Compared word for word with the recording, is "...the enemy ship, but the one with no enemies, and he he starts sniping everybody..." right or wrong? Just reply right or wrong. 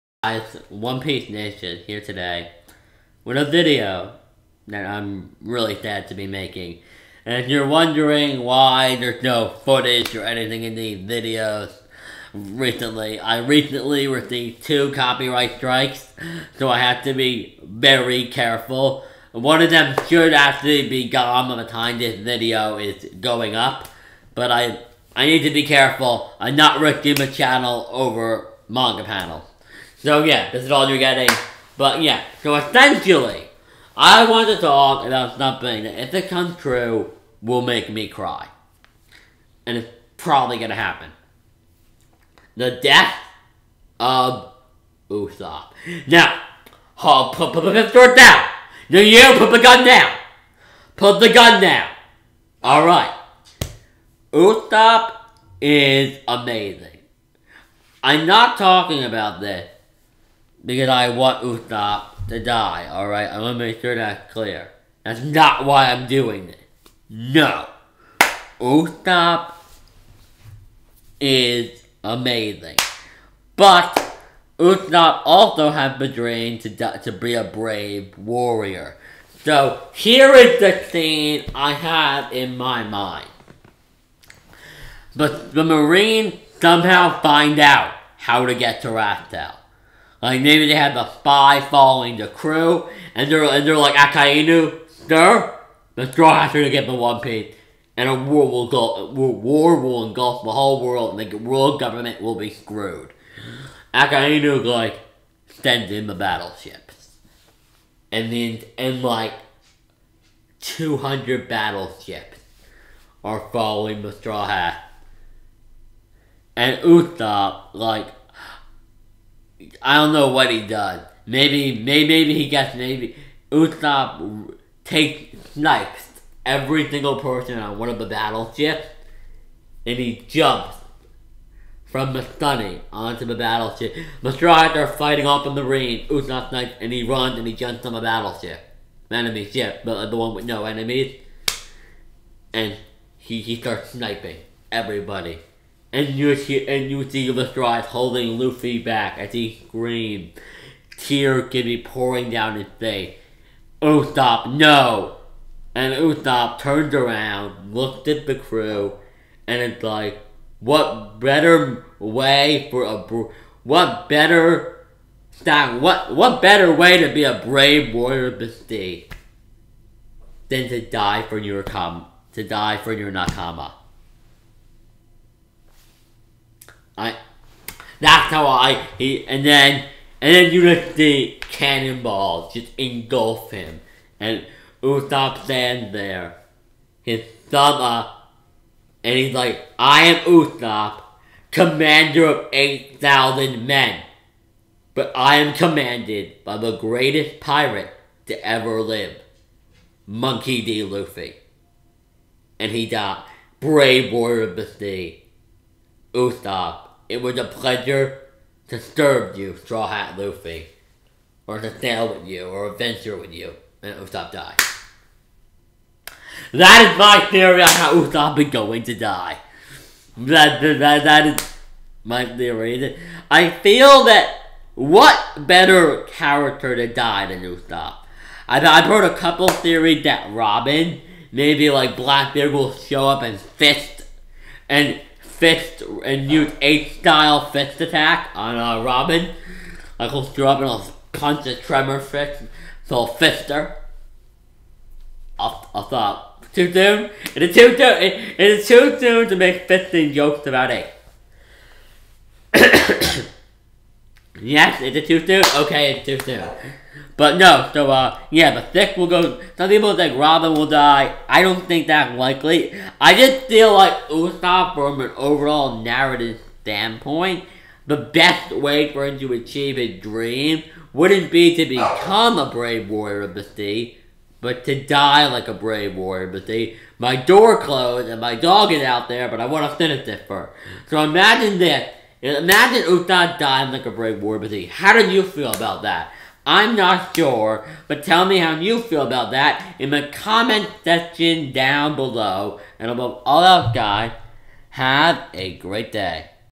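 right.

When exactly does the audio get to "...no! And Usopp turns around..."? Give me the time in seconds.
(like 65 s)
154 s.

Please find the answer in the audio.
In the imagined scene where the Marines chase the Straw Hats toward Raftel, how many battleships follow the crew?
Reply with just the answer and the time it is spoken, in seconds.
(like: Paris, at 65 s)
200, at 110 s.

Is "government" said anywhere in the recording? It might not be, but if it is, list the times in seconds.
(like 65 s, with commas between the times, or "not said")
101 s.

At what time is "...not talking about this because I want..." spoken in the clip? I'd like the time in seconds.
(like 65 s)
58 s.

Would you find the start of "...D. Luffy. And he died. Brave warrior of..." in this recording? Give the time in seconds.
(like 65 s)
200 s.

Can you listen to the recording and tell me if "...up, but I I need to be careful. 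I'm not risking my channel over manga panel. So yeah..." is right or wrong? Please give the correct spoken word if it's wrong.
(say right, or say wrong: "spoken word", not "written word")
right.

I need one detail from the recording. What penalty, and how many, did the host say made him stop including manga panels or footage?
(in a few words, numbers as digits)
2 copyright strikes.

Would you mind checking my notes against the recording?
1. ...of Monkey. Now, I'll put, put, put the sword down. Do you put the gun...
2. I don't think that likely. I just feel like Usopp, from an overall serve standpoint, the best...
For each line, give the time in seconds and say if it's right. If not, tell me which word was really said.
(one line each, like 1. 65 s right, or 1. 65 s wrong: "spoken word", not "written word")
1. 43 s wrong: "Usopp", not "Monkey"
2. 261 s wrong: "narrative", not "serve".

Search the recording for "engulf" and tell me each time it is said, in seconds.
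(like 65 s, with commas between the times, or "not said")
100 s, 182 s.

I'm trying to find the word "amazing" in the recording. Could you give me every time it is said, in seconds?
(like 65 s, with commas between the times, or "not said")
56 s, 72 s.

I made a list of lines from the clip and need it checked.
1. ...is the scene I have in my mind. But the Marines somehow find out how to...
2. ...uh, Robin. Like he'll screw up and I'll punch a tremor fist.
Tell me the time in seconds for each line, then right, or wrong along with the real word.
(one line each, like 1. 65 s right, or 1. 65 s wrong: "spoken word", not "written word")
1. 80 s right
2. 238 s right.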